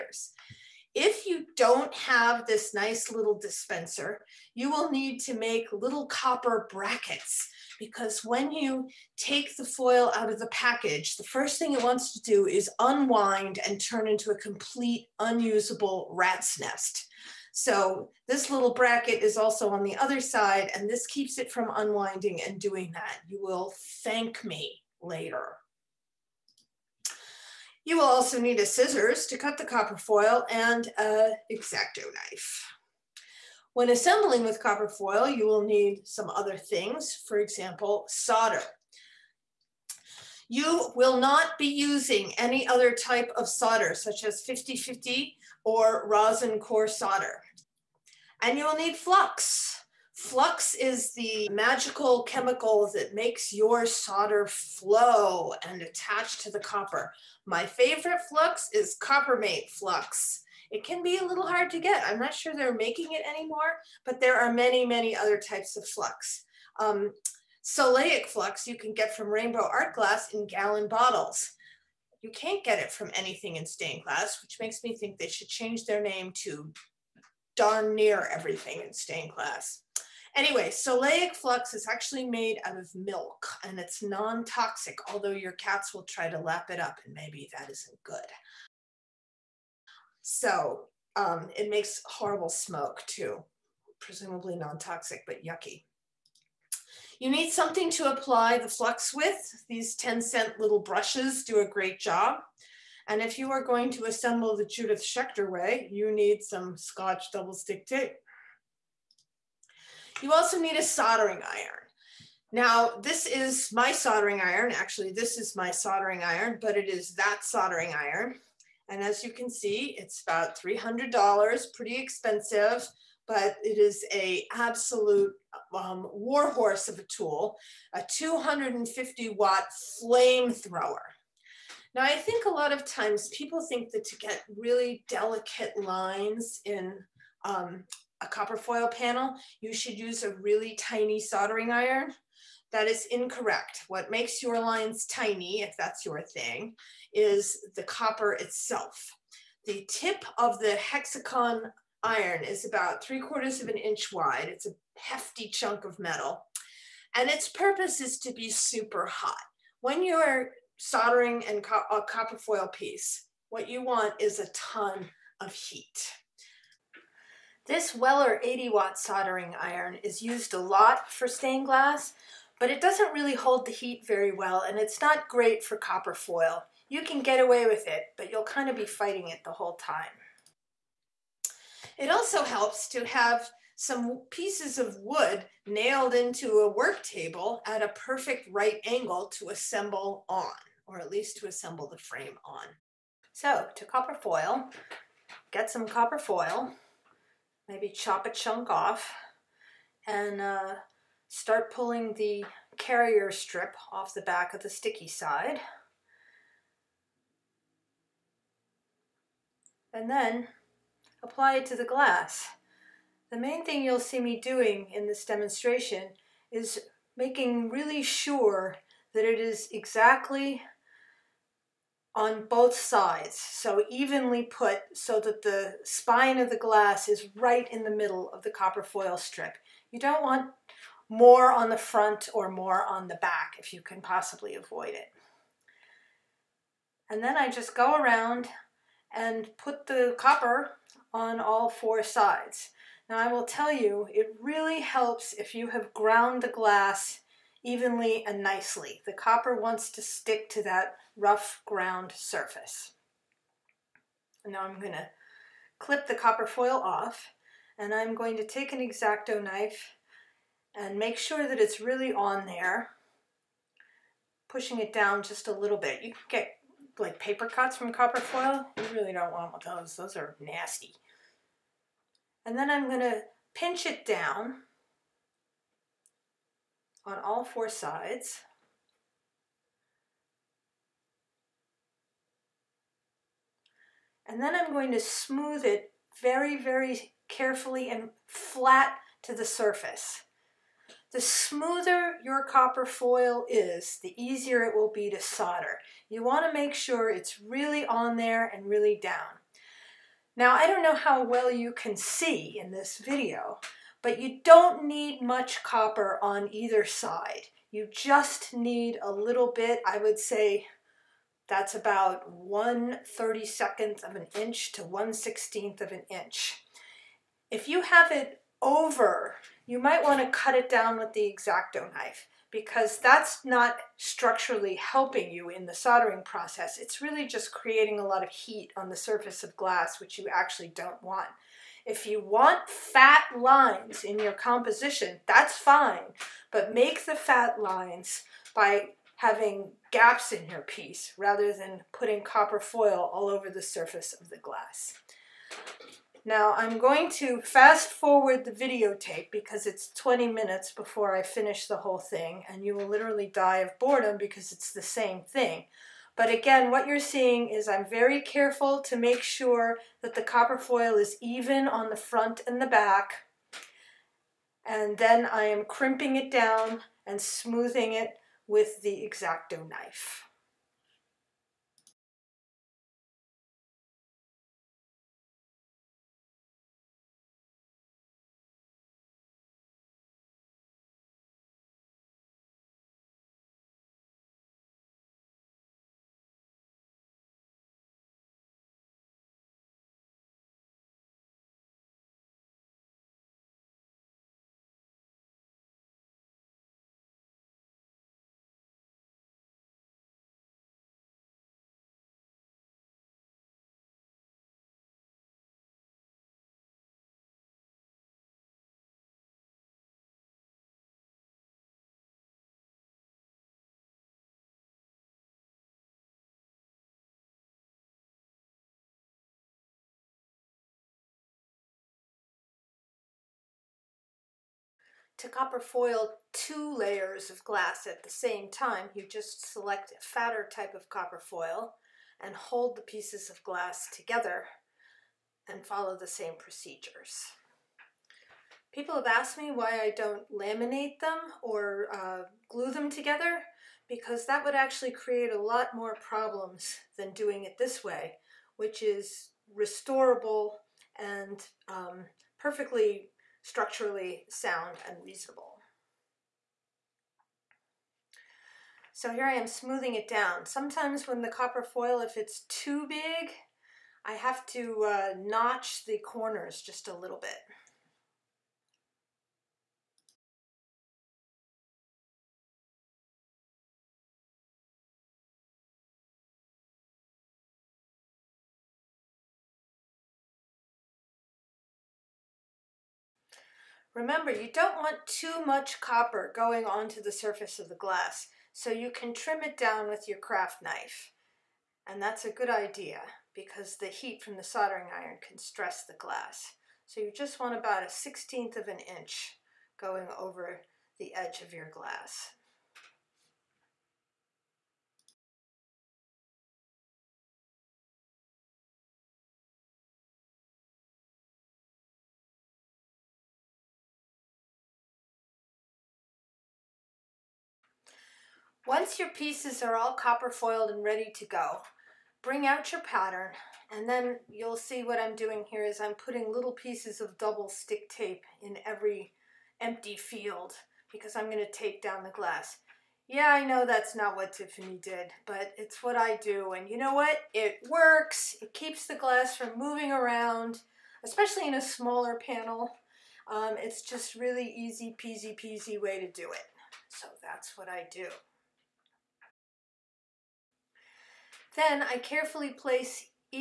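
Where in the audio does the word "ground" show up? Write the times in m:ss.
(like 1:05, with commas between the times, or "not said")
4:05, 4:11.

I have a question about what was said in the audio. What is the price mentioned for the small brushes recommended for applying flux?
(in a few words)
10 cents.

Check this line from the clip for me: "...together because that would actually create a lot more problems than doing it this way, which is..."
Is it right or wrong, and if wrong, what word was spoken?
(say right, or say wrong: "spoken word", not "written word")
right.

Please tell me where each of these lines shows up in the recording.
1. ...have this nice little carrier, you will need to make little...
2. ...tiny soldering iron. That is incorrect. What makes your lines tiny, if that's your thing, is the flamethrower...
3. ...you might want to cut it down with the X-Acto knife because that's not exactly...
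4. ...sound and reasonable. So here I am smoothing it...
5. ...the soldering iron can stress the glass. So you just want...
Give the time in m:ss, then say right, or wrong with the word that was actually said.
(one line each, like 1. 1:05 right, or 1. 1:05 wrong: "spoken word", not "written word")
1. 0:01 wrong: "dispenser", not "carrier"
2. 2:20 wrong: "copper", not "flamethrower"
3. 5:19 wrong: "structurally", not "exactly"
4. 7:34 right
5. 8:14 right.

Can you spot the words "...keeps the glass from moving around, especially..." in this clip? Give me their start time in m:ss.
8:58.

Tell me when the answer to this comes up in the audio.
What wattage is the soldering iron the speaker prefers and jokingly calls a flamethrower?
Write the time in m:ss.
2:08.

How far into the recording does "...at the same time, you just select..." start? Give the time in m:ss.
7:07.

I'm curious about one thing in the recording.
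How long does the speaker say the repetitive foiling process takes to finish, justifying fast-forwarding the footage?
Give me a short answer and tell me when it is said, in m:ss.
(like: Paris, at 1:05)
20 minutes, at 5:49.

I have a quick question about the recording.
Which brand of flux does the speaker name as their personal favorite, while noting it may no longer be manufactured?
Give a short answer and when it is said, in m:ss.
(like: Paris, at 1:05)
Coppermate, at 0:59.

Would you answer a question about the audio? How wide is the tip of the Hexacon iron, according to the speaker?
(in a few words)
3/4 inch.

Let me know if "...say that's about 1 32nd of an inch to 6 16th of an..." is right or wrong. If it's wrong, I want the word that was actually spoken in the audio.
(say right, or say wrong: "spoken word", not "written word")
wrong: "1", not "6".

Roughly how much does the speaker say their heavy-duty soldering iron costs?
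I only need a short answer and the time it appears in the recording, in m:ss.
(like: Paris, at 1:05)
$300, at 2:00.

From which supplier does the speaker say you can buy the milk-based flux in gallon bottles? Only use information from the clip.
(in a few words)
Rainbow Art Glass.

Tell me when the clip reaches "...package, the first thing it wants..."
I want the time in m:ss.
0:10.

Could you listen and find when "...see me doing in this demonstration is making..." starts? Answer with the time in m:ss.
3:34.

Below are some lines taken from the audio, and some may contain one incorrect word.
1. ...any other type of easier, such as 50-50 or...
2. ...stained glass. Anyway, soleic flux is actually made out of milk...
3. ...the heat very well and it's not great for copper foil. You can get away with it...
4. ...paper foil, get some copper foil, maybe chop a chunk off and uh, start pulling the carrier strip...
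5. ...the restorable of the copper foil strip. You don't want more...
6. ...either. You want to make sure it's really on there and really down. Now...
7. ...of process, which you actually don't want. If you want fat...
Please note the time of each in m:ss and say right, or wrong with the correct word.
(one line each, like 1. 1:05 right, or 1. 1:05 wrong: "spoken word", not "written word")
1. 0:42 wrong: "solder", not "easier"
2. 1:18 right
3. 2:53 right
4. 3:13 wrong: "copper", not "paper"
5. 3:47 wrong: "middle", not "restorable"
6. 4:55 wrong: "solder", not "either"
7. 5:29 wrong: "glass", not "process".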